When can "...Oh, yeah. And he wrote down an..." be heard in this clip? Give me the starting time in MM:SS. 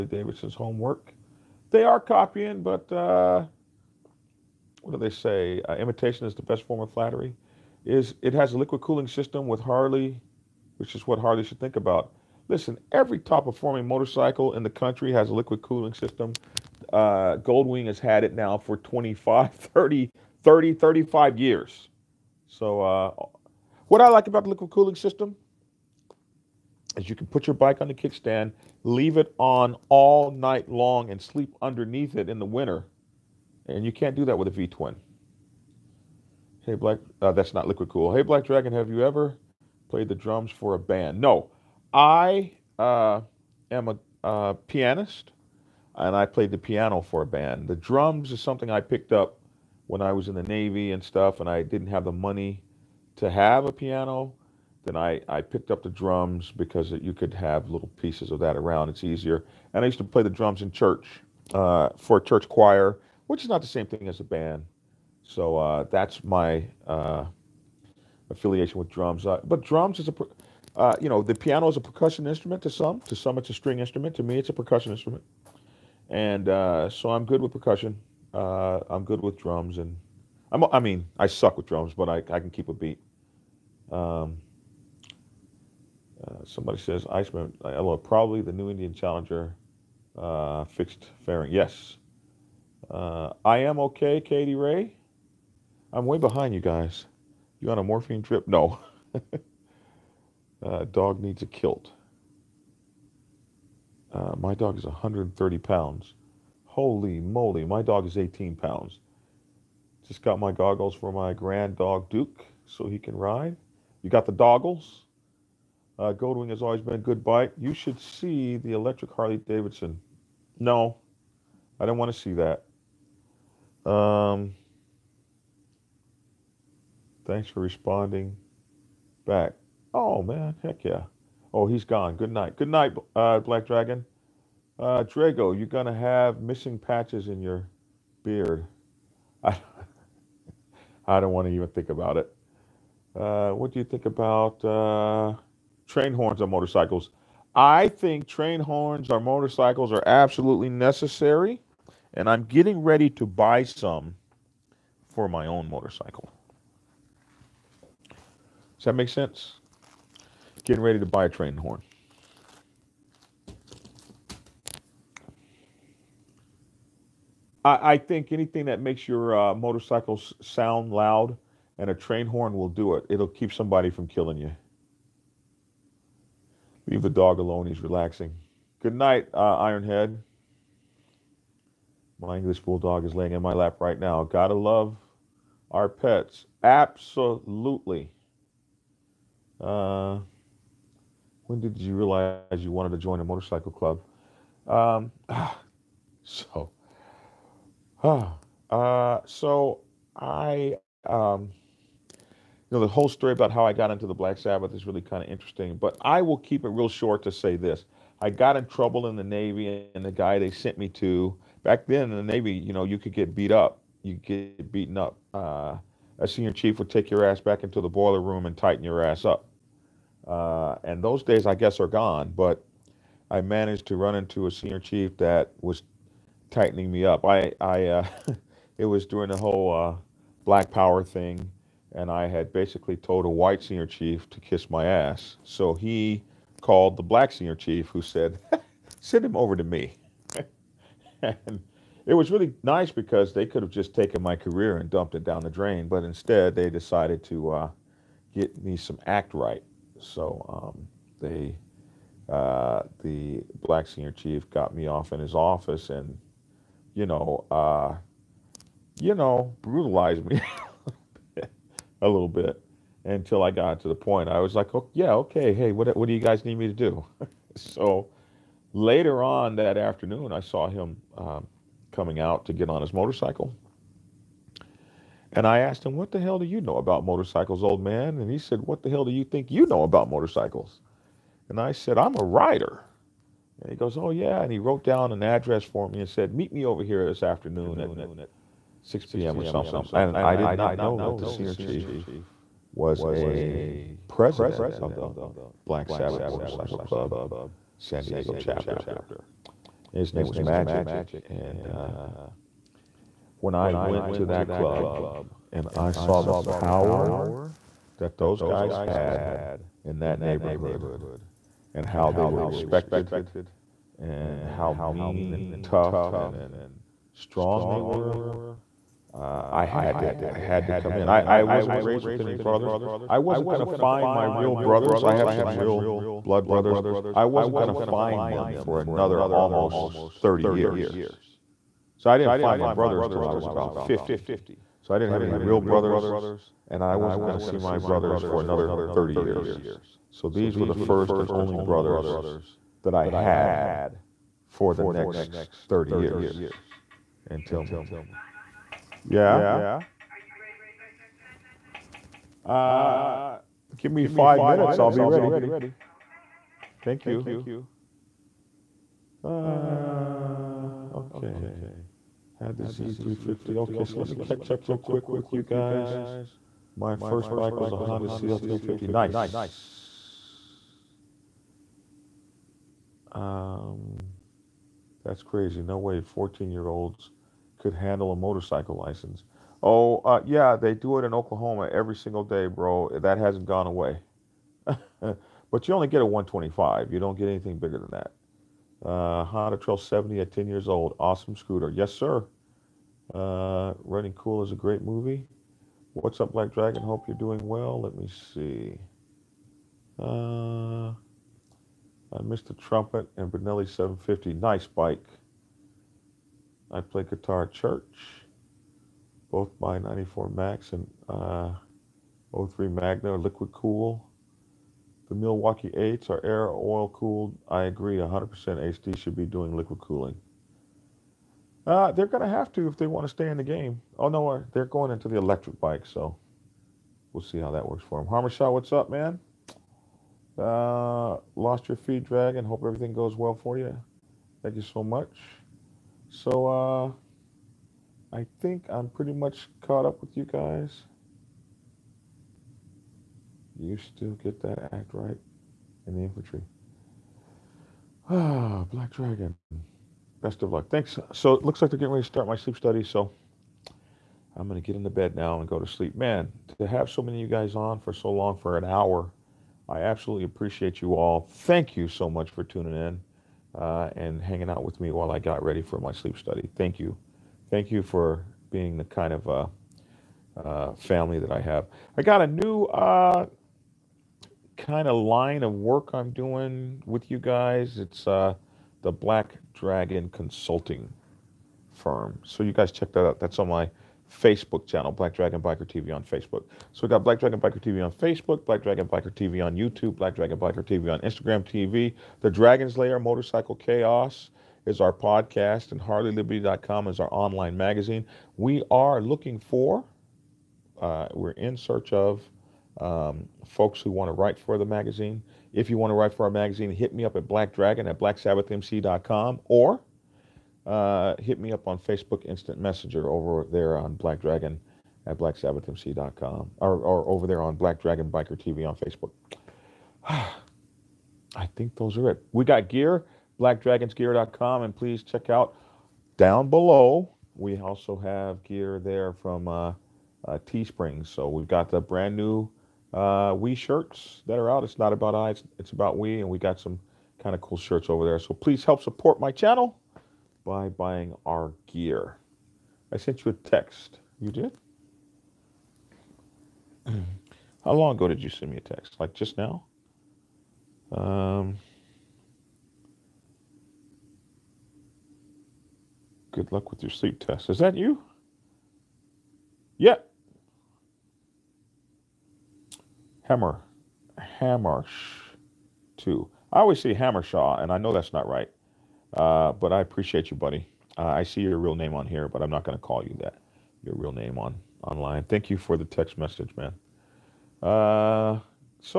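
04:43.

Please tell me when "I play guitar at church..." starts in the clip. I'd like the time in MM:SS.
06:46.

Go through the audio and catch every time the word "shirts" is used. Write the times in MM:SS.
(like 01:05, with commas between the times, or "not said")
08:53, 08:57.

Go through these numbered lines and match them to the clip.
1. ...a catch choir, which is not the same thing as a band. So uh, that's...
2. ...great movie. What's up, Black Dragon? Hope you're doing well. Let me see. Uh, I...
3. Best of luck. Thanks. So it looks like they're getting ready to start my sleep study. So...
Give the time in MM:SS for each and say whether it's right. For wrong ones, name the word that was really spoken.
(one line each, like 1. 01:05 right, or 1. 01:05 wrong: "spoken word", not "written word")
1. 01:02 wrong: "church", not "catch"
2. 06:34 right
3. 07:30 right.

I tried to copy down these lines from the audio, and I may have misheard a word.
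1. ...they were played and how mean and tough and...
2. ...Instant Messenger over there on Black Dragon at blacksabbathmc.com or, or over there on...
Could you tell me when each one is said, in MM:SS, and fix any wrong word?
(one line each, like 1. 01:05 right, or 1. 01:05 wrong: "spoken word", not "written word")
1. 05:12 wrong: "respected", not "played"
2. 08:32 right.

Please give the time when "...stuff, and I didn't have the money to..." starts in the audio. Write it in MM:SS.
00:51.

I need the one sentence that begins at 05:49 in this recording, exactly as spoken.
Are you ready to start your study?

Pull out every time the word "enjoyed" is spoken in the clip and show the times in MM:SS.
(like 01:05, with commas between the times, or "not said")
not said.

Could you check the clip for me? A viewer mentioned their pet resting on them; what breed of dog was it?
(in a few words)
English bulldog.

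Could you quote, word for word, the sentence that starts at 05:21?
I, I wasn't raised with any brothers.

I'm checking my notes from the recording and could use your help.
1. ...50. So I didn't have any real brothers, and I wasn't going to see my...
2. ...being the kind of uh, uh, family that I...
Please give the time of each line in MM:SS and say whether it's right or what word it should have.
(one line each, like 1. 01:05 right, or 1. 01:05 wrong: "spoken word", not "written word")
1. 05:33 right
2. 07:48 right.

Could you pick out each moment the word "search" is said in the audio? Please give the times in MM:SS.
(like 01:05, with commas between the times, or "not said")
08:21.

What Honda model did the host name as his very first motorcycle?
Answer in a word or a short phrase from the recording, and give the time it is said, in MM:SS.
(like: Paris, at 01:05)
Honda CL350, at 06:07.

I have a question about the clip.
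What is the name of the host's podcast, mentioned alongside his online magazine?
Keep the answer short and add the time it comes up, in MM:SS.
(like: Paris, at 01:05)
The Dragon's Lair Motorcycle Chaos, at 08:12.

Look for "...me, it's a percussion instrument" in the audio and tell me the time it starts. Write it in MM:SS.
01:14.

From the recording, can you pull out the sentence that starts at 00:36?
Hey, Black, uh, that's not liquid cool.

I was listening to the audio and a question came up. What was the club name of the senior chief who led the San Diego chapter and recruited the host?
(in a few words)
Magic.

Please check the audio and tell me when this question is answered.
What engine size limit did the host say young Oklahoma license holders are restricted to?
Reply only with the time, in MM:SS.
06:25.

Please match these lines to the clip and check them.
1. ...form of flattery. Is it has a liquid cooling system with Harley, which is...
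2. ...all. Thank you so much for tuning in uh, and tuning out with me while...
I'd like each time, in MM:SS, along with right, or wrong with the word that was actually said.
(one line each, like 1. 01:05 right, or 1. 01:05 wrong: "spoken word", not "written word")
1. 00:06 right
2. 07:40 wrong: "hanging", not "tuning".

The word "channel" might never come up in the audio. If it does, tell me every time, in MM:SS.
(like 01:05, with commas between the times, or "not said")
08:04, 08:59.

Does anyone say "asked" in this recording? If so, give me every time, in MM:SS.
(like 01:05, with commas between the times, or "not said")
04:35.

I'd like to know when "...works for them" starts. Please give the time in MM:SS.
07:07.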